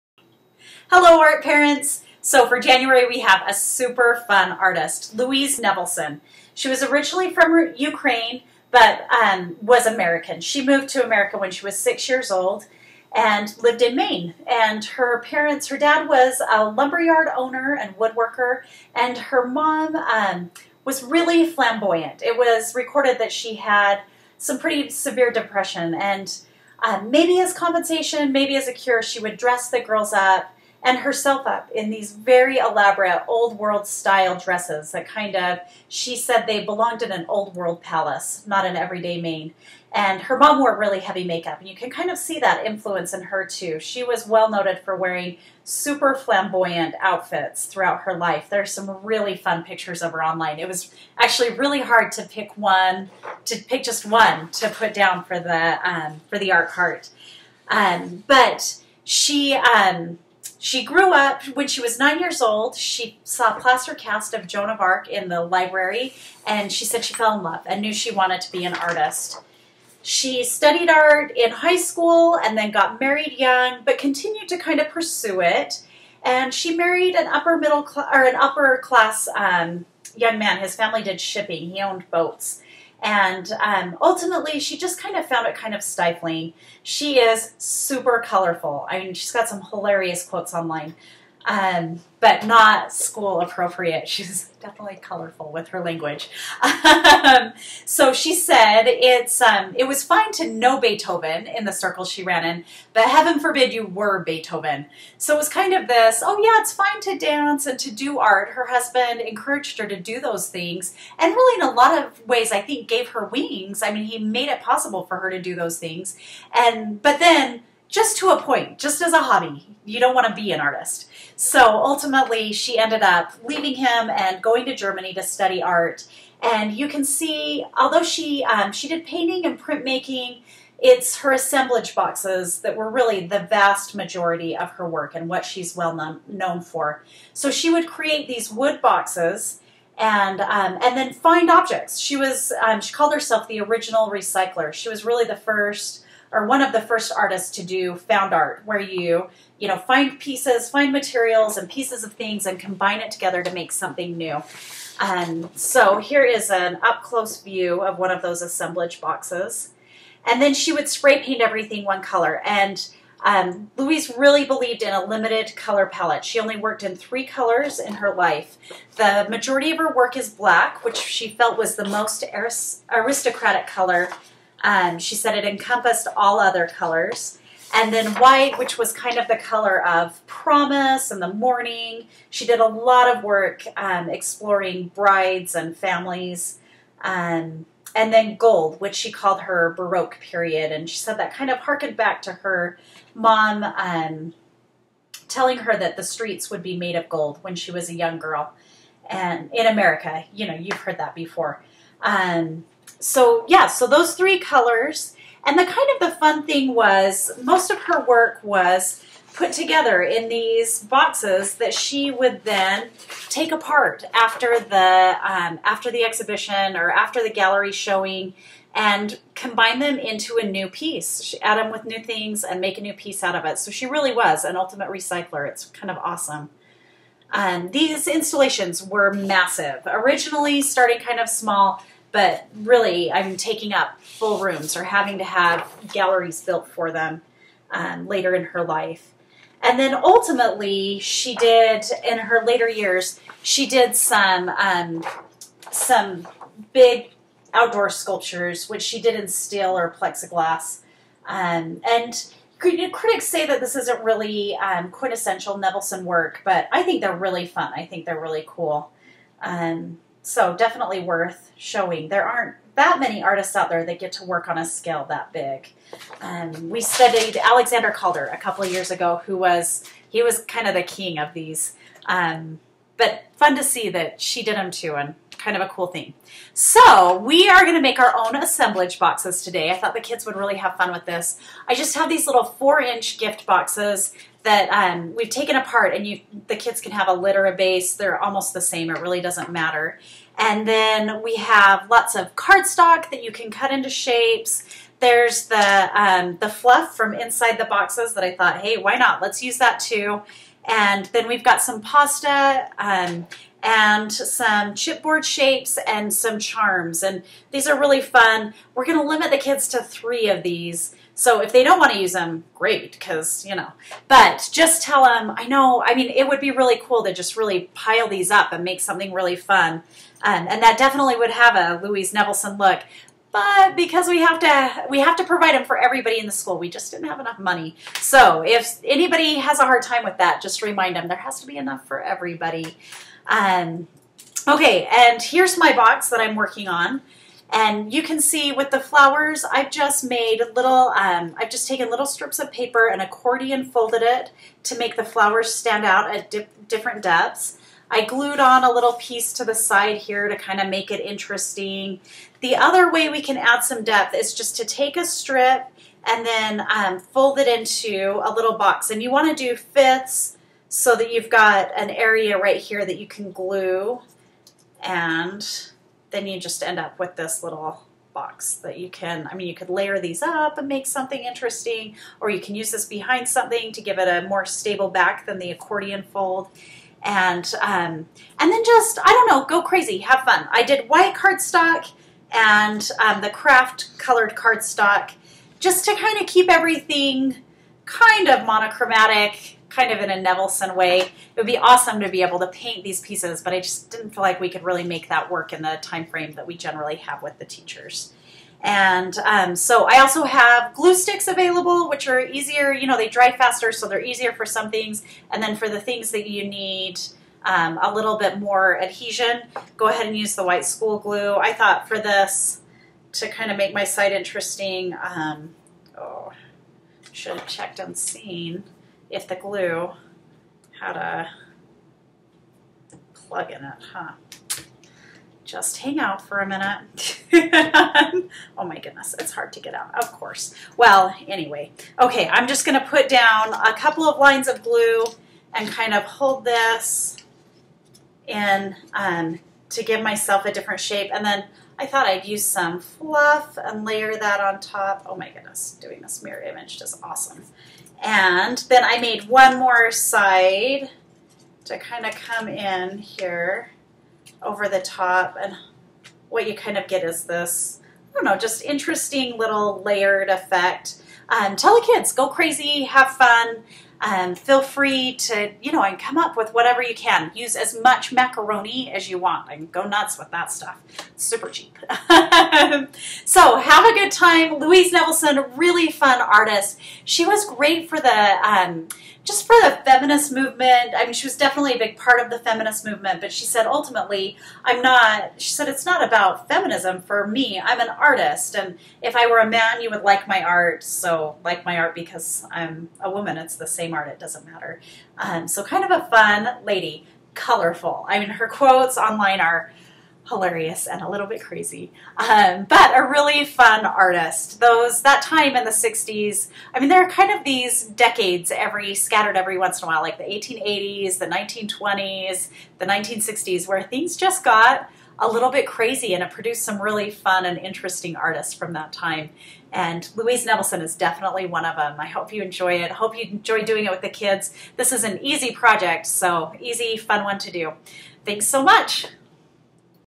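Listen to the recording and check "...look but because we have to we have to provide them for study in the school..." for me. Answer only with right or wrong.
wrong.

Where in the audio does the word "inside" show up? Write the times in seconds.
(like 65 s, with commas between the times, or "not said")
297 s.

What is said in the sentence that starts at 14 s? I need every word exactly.
And her parents, her dad was a lumberyard owner and woodworker, and her mom um, was really flamboyant.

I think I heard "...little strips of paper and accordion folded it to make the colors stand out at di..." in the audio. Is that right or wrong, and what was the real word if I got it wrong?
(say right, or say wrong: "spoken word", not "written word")
wrong: "flowers", not "colors".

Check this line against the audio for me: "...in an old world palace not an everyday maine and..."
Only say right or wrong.
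right.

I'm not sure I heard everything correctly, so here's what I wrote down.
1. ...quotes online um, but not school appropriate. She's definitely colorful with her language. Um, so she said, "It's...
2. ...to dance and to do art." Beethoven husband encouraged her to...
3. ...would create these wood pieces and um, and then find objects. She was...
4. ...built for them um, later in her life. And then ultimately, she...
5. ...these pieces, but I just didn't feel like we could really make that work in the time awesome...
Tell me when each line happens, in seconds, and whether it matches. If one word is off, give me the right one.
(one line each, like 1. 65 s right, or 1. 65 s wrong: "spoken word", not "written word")
1. 90 s right
2. 107 s wrong: "Her", not "Beethoven"
3. 137 s wrong: "boxes", not "pieces"
4. 236 s right
5. 392 s wrong: "frame", not "awesome".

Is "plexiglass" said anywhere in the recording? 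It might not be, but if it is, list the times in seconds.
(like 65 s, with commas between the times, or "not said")
250 s.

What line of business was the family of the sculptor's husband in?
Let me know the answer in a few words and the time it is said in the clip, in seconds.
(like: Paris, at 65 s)
shipping, at 80 s.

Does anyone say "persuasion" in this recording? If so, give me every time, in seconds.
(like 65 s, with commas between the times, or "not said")
not said.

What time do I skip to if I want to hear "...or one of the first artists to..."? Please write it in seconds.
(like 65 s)
146 s.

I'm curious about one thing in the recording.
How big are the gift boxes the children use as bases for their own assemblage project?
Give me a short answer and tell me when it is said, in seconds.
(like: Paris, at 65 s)
4 inch, at 282 s.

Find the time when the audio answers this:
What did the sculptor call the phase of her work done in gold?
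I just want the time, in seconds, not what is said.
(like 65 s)
189 s.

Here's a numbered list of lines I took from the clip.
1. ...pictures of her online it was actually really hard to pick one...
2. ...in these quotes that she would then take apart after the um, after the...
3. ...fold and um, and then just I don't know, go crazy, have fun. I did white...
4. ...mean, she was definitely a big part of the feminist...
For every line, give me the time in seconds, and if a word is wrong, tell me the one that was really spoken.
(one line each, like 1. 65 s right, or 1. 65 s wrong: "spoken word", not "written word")
1. 49 s right
2. 210 s wrong: "boxes", not "quotes"
3. 376 s right
4. 481 s right.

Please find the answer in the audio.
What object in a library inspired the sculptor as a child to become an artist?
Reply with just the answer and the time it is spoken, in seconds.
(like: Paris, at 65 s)
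plaster cast of Joan of Arc, at 63 s.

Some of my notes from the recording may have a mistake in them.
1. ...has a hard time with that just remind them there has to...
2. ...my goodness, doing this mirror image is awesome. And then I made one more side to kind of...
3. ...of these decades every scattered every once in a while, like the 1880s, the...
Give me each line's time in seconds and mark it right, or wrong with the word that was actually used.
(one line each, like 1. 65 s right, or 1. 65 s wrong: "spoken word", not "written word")
1. 329 s right
2. 445 s right
3. 507 s right.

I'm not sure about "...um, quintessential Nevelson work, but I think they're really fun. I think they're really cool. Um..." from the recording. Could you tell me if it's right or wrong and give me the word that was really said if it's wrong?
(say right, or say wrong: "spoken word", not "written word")
right.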